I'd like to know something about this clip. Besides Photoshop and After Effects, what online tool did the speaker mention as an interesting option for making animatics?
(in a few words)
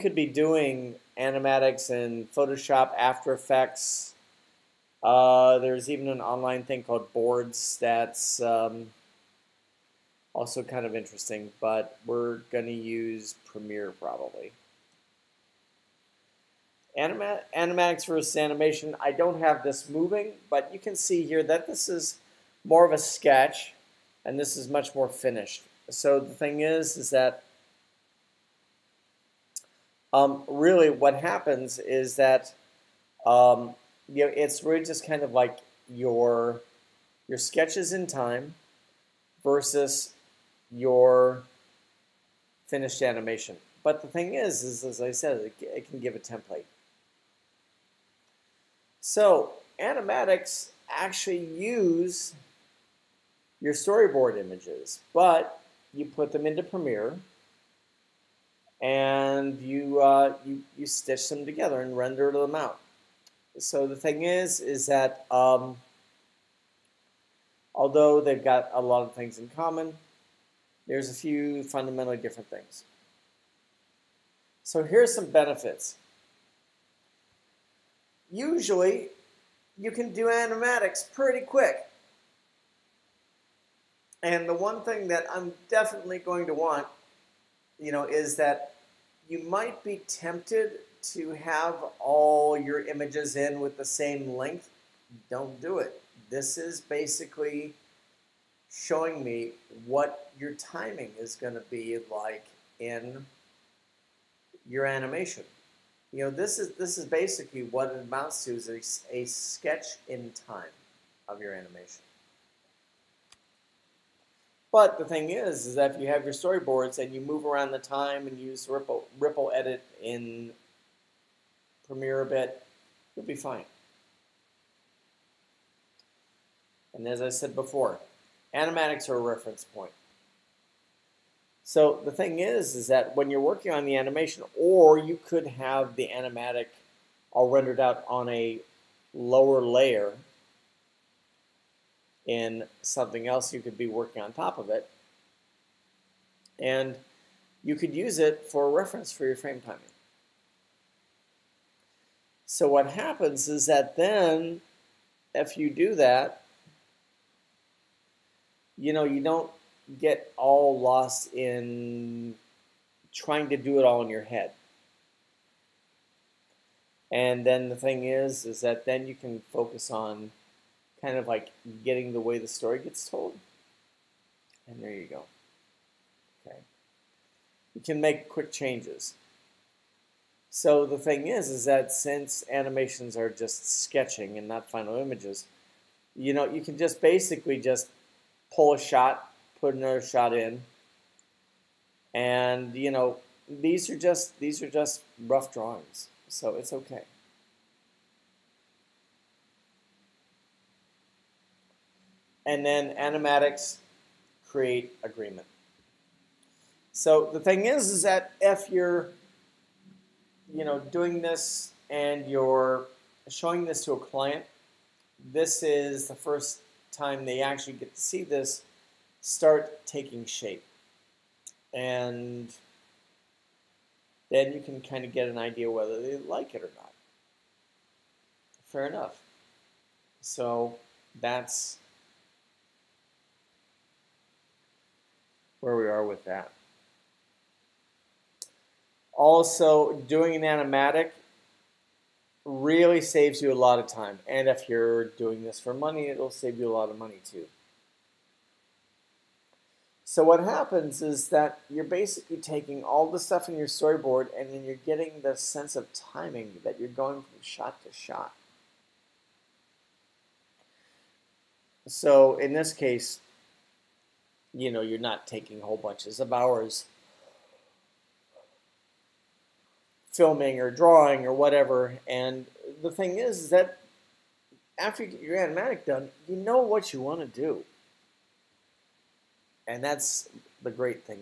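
Boords.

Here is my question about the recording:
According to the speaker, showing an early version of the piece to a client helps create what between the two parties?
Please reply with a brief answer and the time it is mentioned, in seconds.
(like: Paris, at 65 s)
agreement, at 205 s.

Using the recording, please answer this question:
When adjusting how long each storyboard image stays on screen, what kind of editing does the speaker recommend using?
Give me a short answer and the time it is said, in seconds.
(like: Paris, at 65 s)
ripple edit, at 118 s.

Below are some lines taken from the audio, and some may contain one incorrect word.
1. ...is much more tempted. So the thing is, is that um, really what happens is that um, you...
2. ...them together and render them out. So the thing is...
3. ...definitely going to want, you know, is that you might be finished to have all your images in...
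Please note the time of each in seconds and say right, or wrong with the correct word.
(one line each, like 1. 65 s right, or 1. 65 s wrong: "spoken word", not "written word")
1. 24 s wrong: "finished", not "tempted"
2. 61 s right
3. 85 s wrong: "tempted", not "finished".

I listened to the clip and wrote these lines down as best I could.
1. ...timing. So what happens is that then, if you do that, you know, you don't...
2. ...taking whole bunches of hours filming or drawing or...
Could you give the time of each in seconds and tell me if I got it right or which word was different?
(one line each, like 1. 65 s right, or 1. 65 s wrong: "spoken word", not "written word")
1. 149 s right
2. 265 s right.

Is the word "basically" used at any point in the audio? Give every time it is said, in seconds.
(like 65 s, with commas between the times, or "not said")
96 s, 107 s, 187 s, 251 s.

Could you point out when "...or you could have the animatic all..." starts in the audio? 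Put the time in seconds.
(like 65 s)
134 s.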